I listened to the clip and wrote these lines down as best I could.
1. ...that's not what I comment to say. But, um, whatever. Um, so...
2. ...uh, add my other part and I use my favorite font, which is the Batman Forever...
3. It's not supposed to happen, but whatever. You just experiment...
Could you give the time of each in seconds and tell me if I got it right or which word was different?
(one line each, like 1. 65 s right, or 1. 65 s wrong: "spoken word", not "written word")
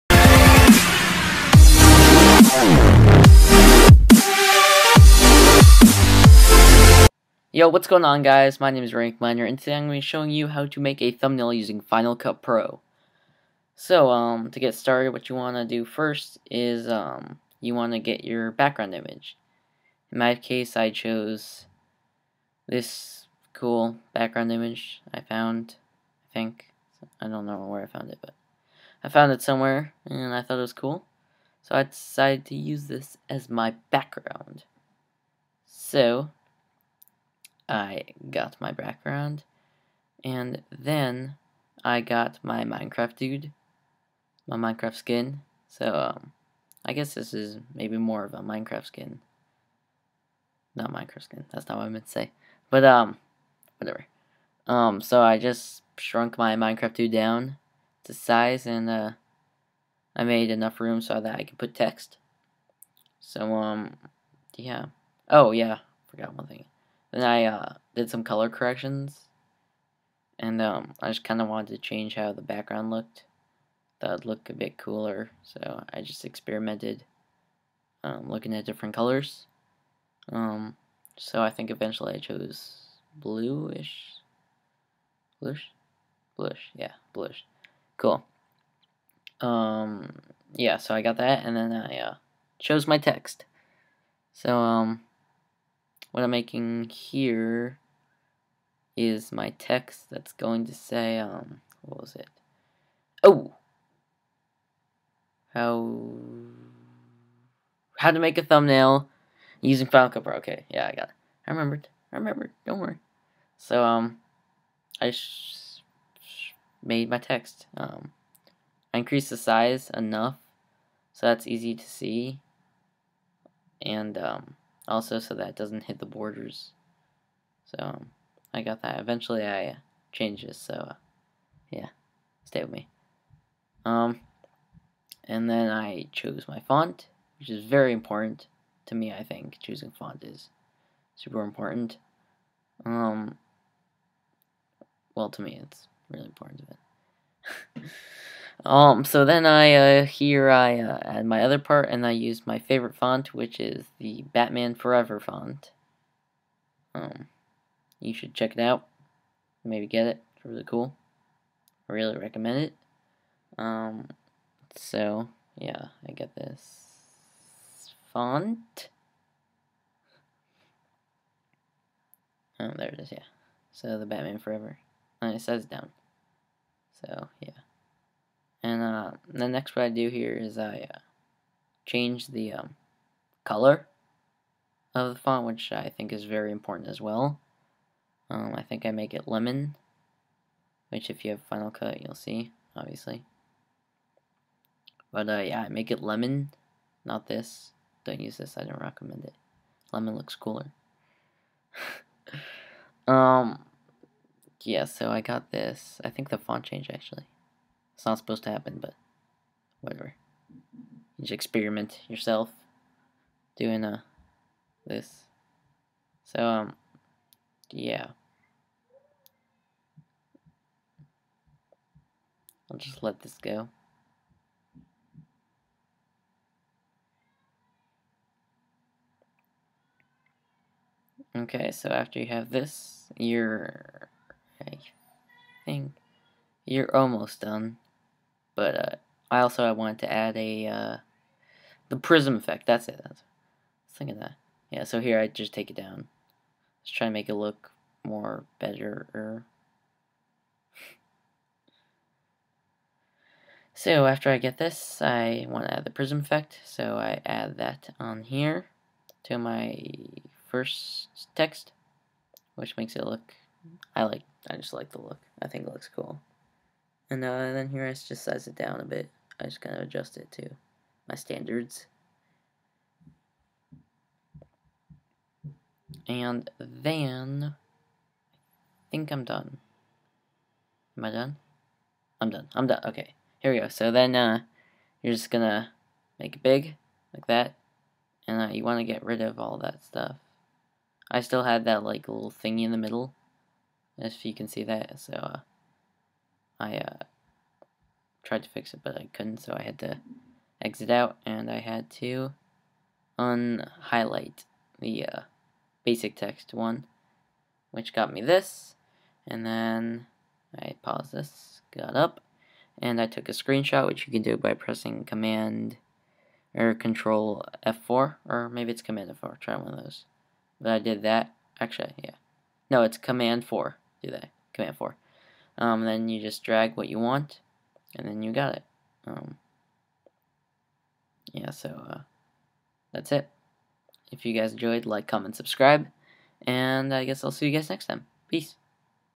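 1. 51 s wrong: "meant", not "comment"
2. 150 s right
3. 208 s right.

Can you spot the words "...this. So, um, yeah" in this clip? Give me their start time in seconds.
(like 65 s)
214 s.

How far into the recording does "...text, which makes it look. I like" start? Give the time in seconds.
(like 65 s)
261 s.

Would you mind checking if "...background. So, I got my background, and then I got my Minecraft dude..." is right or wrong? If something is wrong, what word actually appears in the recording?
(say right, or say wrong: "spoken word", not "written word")
right.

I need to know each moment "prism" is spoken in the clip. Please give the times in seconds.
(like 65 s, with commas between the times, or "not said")
241 s, 255 s.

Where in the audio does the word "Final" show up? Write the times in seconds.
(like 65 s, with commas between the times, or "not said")
11 s, 109 s, 191 s.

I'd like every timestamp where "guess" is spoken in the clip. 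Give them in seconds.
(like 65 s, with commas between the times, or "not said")
46 s, 337 s.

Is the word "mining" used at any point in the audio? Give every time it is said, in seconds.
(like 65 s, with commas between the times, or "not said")
not said.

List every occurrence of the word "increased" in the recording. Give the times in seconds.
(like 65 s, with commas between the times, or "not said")
118 s.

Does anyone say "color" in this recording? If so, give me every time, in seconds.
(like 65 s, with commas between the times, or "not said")
68 s, 78 s, 183 s.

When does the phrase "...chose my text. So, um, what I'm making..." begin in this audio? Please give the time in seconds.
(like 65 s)
92 s.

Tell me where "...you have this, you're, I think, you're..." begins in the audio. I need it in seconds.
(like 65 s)
232 s.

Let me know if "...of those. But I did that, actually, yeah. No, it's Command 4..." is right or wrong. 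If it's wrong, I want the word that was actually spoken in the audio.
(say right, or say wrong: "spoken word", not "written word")
right.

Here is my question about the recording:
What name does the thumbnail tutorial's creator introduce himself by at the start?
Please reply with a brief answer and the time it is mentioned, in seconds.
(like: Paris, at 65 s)
Rank Miner, at 8 s.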